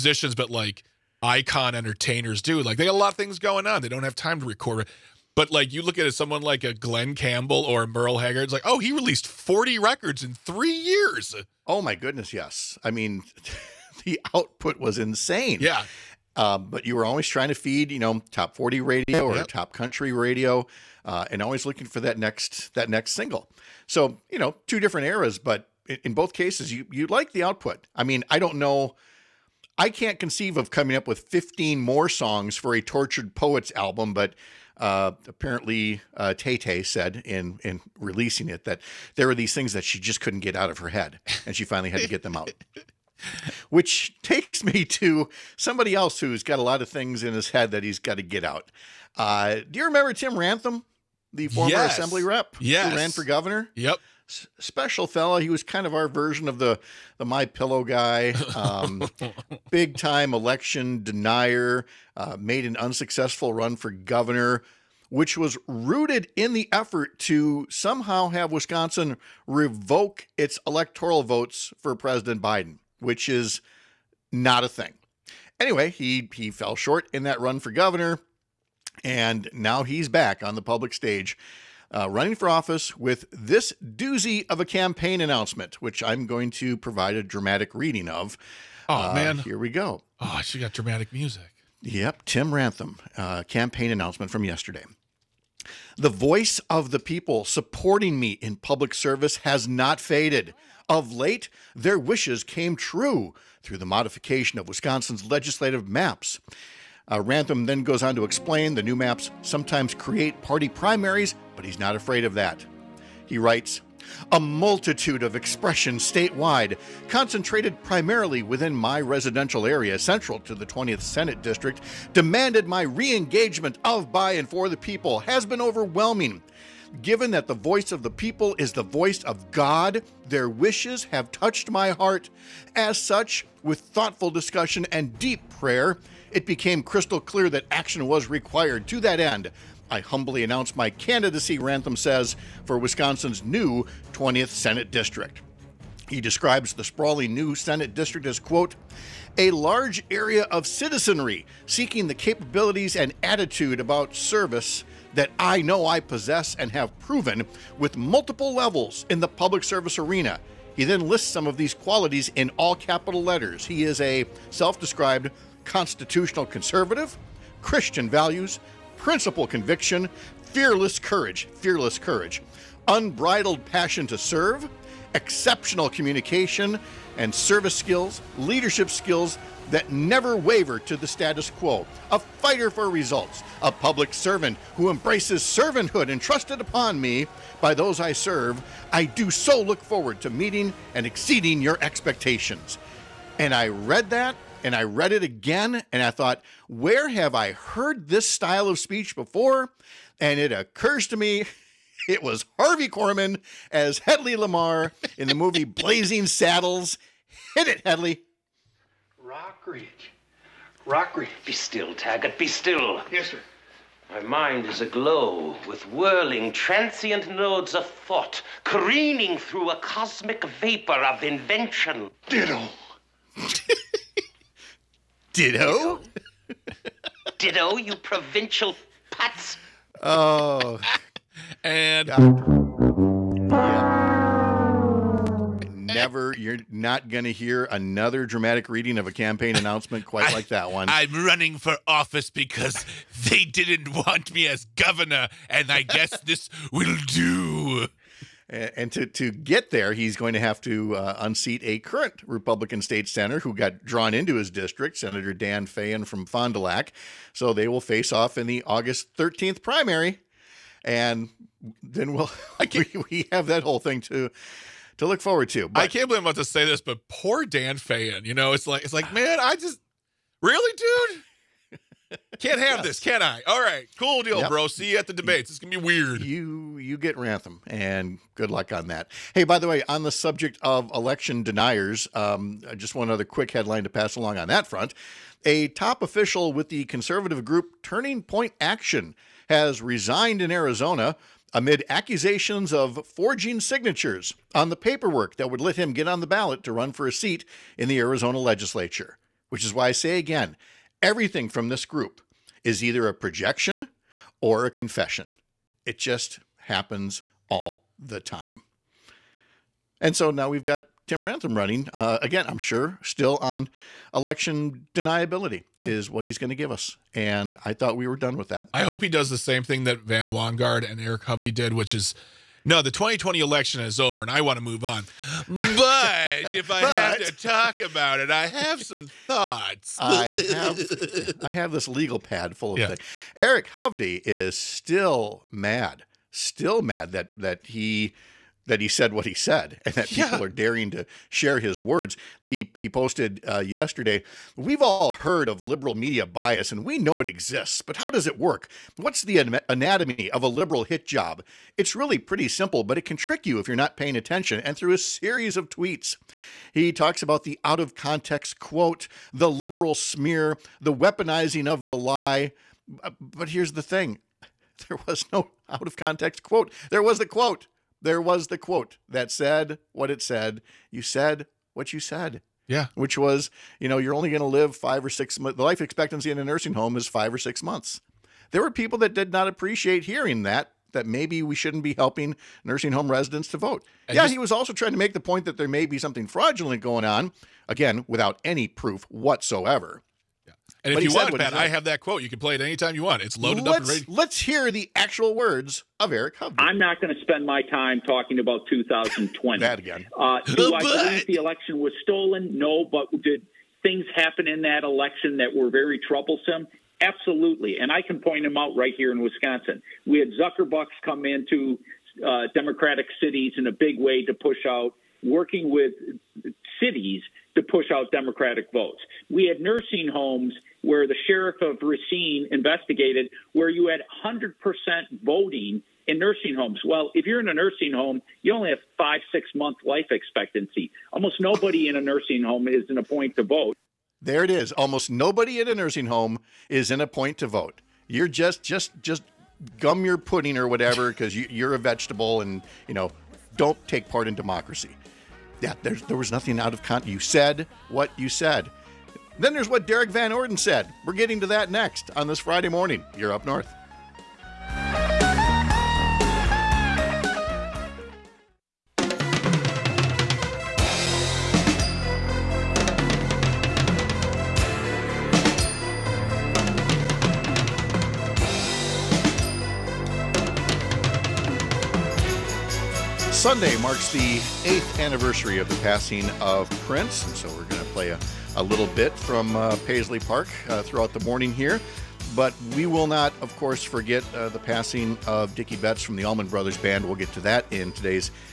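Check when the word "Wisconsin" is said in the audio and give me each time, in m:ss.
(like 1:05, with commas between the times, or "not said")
1:08, 1:44, 2:22, 6:49.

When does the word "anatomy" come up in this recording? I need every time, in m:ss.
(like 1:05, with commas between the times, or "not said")
5:49.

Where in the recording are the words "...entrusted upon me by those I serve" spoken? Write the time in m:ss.
3:06.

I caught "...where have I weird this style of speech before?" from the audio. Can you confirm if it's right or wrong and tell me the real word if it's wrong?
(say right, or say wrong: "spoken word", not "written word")
wrong: "heard", not "weird".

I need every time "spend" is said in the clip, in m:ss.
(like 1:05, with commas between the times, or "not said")
6:37.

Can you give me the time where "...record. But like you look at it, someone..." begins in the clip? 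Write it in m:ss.
0:04.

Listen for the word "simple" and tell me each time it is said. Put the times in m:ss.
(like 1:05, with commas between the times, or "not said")
5:52.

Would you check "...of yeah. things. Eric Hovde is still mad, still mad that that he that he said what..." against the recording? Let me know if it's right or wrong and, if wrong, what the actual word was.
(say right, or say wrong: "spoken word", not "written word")
right.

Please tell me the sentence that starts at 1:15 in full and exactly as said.
Anyway, he he fell short in that run for governor.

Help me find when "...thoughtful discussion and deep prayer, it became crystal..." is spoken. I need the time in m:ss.
2:13.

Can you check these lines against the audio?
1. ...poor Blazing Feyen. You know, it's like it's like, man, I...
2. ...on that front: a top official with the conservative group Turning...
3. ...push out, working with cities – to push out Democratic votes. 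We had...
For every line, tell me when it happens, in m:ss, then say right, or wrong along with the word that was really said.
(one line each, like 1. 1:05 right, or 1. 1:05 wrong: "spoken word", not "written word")
1. 4:27 wrong: "Dan", not "Blazing"
2. 4:44 right
3. 6:54 right.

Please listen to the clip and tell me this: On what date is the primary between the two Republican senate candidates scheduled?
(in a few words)
August 13.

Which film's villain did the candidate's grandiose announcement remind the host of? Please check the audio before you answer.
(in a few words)
Blazing Saddles.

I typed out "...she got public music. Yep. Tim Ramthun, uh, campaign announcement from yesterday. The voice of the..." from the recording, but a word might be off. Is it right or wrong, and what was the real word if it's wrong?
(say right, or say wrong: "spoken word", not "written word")
wrong: "dramatic", not "public".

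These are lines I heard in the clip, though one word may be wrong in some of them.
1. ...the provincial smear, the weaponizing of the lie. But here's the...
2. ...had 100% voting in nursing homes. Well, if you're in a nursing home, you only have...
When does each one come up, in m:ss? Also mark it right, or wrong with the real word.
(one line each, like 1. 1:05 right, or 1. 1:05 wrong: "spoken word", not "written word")
1. 5:59 wrong: "liberal", not "provincial"
2. 7:03 right.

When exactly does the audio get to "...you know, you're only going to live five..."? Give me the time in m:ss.
6:13.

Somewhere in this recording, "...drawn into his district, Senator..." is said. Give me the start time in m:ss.
4:13.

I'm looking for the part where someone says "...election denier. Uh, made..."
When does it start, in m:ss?
1:00.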